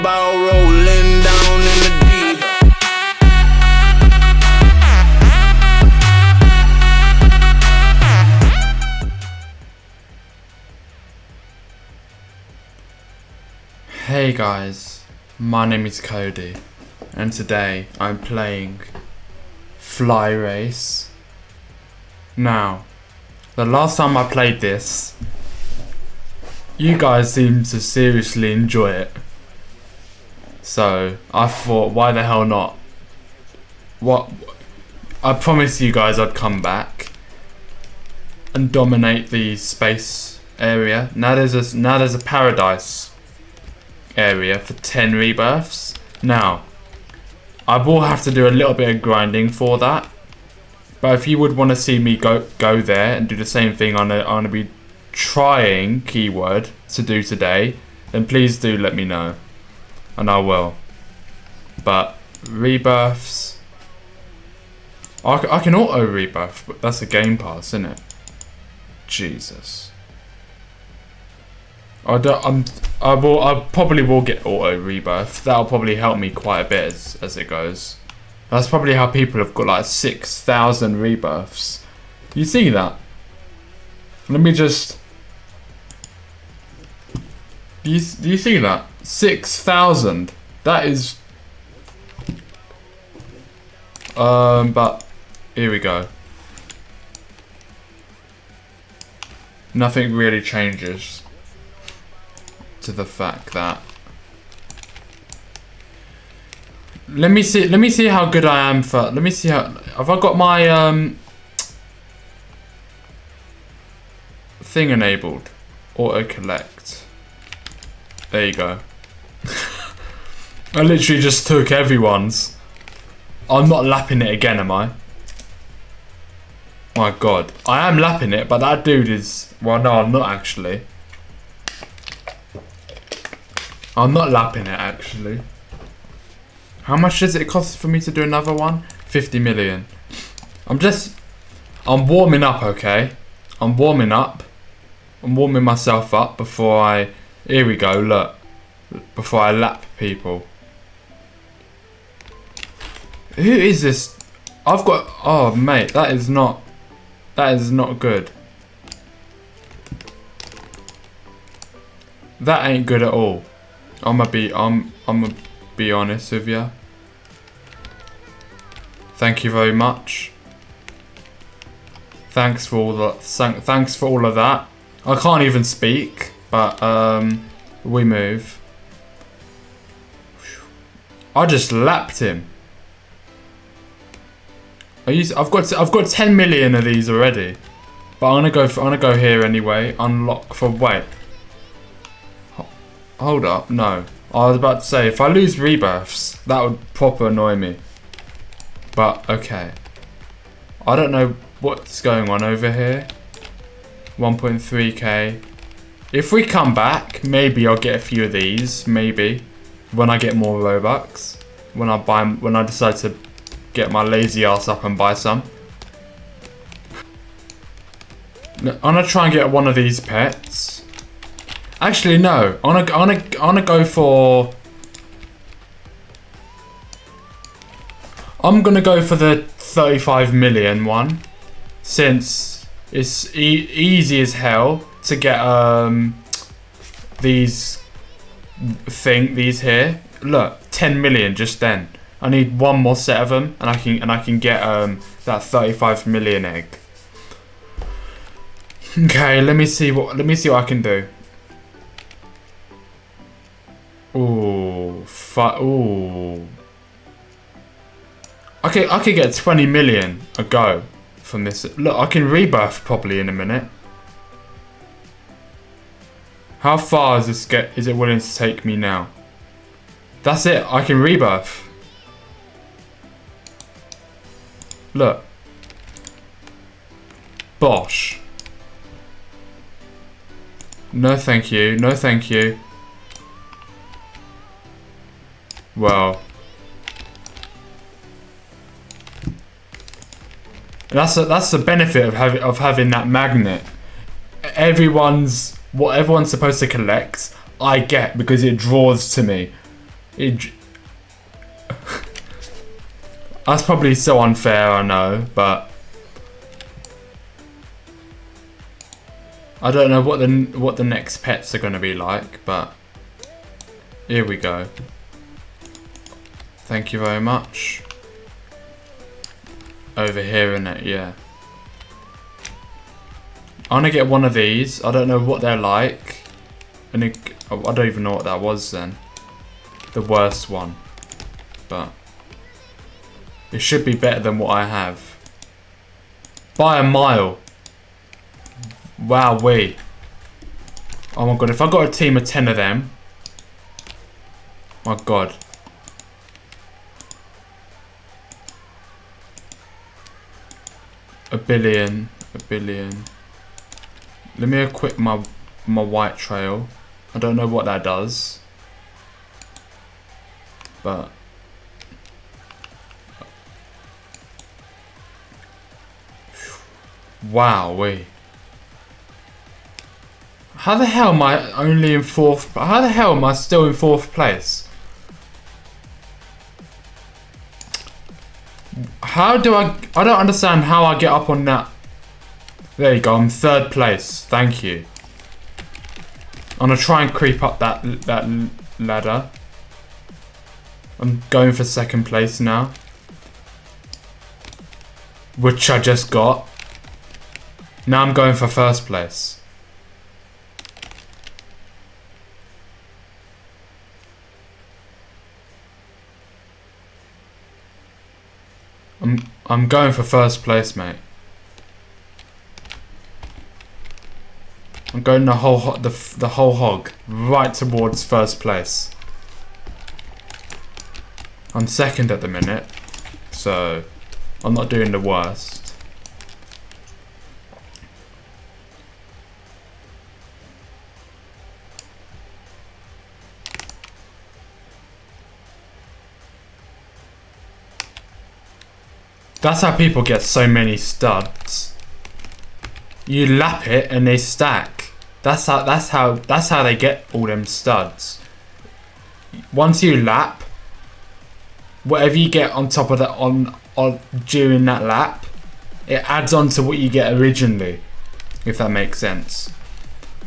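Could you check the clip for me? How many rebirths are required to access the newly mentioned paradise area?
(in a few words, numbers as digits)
10.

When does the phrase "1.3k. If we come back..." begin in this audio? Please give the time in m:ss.
3:24.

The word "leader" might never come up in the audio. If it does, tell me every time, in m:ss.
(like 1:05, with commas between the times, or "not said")
not said.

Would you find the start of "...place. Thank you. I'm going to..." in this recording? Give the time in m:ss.
6:23.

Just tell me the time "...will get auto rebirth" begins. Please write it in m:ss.
1:14.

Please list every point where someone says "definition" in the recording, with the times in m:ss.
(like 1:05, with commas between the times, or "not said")
not said.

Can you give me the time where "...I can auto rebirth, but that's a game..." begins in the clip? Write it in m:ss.
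1:05.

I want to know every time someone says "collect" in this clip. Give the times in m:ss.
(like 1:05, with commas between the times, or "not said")
1:56, 4:56.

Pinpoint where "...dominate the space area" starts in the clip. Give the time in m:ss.
0:38.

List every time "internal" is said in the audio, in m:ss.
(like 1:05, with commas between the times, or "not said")
not said.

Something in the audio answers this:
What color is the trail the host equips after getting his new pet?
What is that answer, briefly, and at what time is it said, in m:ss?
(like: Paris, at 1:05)
white, at 5:55.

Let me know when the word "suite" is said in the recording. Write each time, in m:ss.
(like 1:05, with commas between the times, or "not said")
not said.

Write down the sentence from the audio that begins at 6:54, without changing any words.
I'm going the whole the the whole hog right towards first place.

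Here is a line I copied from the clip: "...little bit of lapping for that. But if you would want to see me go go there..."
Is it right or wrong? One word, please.
wrong.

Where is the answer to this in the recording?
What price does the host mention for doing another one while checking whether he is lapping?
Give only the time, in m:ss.
2:19.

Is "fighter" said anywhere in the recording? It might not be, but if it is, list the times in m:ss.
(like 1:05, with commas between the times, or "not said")
not said.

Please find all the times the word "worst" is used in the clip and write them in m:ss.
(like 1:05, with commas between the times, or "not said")
5:30, 7:04.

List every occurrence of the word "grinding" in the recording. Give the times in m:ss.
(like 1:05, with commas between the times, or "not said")
0:49.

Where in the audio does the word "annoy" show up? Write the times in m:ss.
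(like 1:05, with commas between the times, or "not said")
3:17.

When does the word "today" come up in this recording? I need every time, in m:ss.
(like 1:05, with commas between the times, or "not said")
0:17, 0:57.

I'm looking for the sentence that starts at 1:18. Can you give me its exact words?
That's probably how people have got like 6,000 rebirths.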